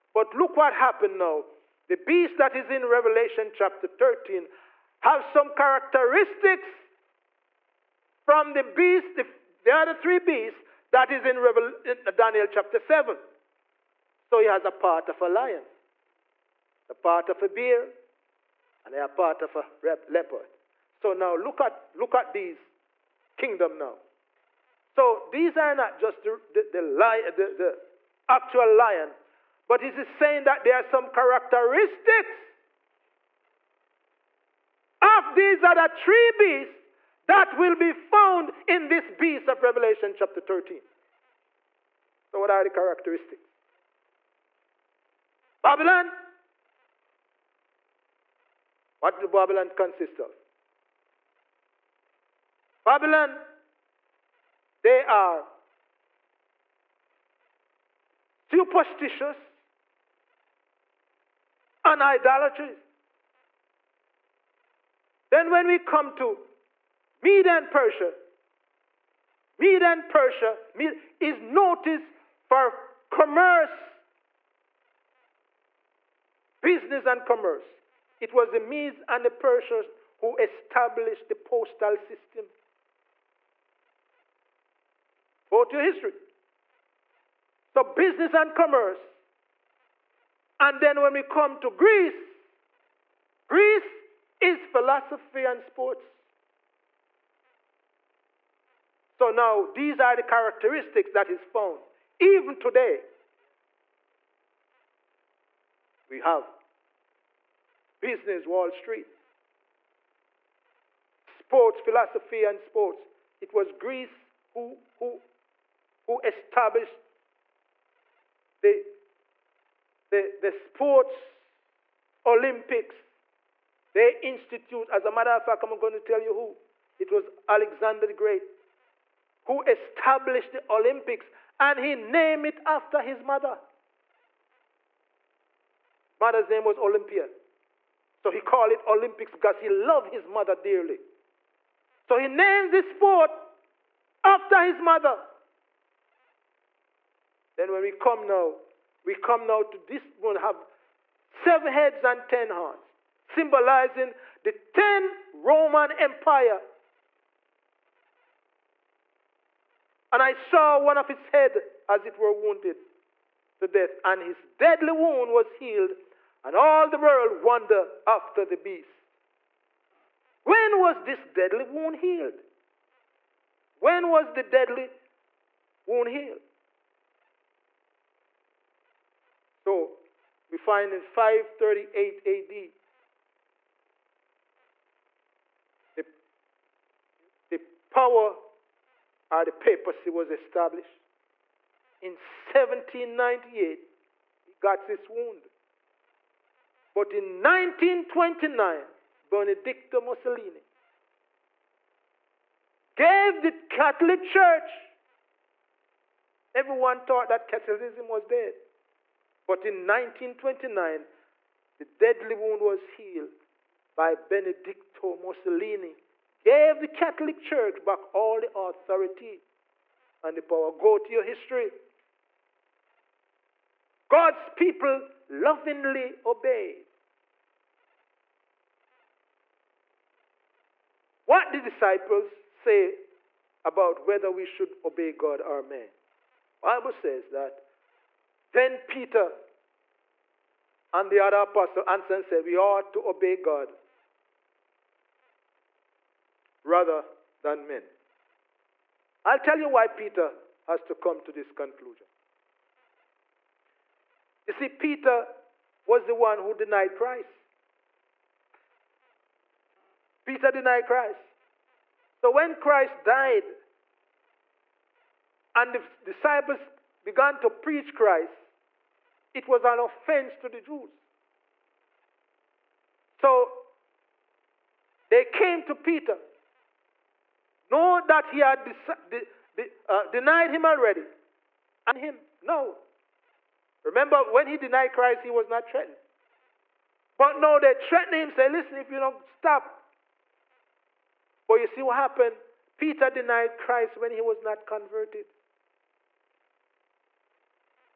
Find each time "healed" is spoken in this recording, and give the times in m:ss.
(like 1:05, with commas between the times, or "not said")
2:45, 2:51, 2:56, 3:32.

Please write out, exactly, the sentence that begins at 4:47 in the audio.
But no, they threatened him, say, listen, if you don't stop.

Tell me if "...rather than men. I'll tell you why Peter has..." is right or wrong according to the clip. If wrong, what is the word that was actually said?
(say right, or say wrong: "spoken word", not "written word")
right.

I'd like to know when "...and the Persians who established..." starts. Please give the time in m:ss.
1:19.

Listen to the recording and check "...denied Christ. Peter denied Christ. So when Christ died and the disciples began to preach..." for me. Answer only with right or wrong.
right.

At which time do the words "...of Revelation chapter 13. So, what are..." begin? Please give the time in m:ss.
0:39.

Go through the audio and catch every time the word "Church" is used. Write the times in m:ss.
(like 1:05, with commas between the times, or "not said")
3:24, 3:37.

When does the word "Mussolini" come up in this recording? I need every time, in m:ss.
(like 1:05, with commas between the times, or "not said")
3:20, 3:35.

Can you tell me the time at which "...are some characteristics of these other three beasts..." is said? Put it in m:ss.
0:30.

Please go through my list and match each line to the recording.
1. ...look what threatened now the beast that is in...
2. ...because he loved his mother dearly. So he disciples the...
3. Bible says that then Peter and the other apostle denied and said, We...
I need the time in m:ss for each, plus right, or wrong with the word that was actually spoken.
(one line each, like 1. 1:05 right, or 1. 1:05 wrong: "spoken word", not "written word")
1. 0:00 wrong: "happened", not "threatened"
2. 2:19 wrong: "names", not "disciples"
3. 3:56 wrong: "answered", not "denied".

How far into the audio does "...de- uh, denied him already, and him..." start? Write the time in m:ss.
4:39.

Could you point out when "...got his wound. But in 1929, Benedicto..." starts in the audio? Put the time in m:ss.
3:14.